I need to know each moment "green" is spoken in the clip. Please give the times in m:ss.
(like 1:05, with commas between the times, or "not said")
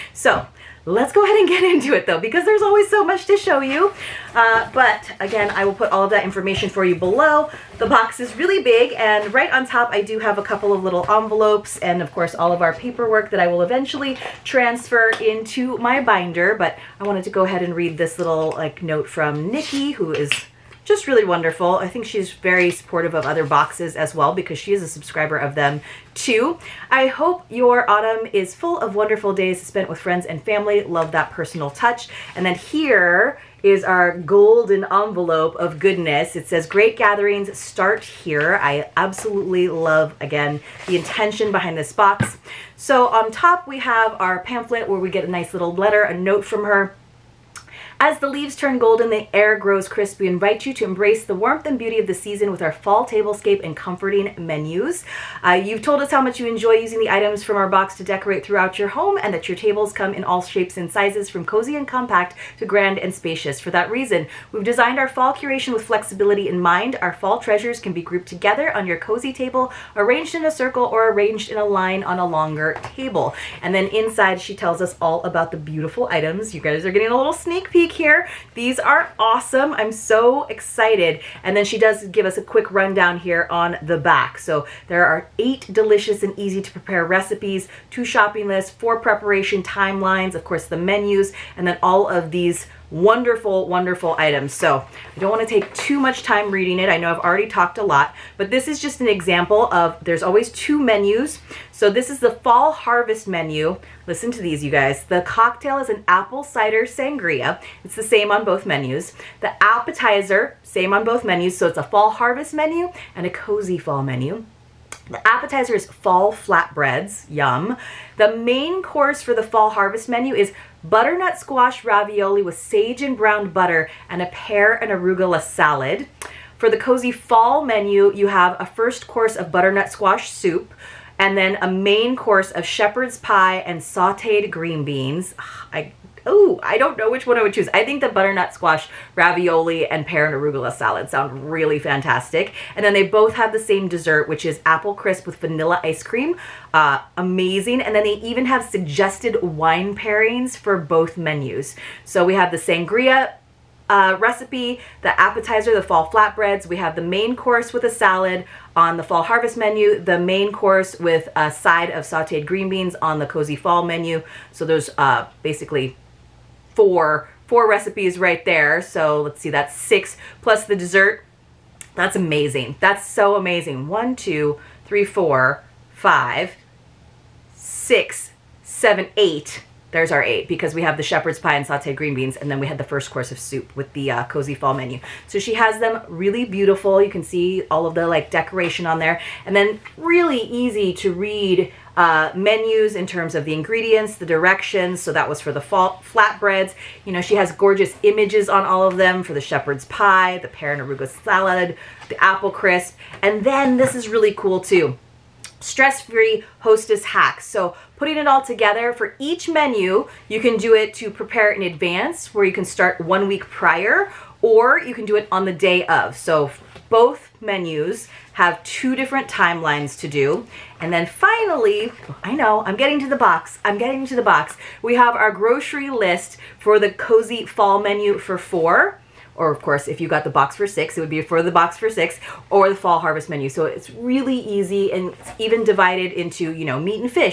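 2:14, 2:42, 3:01.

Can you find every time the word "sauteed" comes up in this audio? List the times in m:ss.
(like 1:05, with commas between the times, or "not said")
2:13, 2:42, 3:01.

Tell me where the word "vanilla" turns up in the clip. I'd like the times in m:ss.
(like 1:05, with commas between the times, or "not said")
2:25.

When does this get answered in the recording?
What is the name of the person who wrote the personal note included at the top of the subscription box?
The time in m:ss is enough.
0:19.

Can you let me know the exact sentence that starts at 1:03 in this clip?
For that reason, we've designed our fall curation with flexibility in mind.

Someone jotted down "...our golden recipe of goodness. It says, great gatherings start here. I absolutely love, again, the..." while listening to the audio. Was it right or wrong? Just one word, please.
wrong.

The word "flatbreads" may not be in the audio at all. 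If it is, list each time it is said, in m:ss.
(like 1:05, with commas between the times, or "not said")
1:56, 2:36, 3:15.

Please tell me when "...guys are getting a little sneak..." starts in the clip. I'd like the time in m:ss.
1:16.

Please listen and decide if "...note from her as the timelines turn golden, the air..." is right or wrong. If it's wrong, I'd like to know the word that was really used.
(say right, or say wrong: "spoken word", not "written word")
wrong: "leaves", not "timelines".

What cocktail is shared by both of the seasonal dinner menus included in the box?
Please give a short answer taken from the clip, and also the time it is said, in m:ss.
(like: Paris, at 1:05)
apple cider sangria, at 1:46.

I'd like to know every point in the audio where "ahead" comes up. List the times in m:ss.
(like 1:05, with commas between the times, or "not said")
0:01, 0:17.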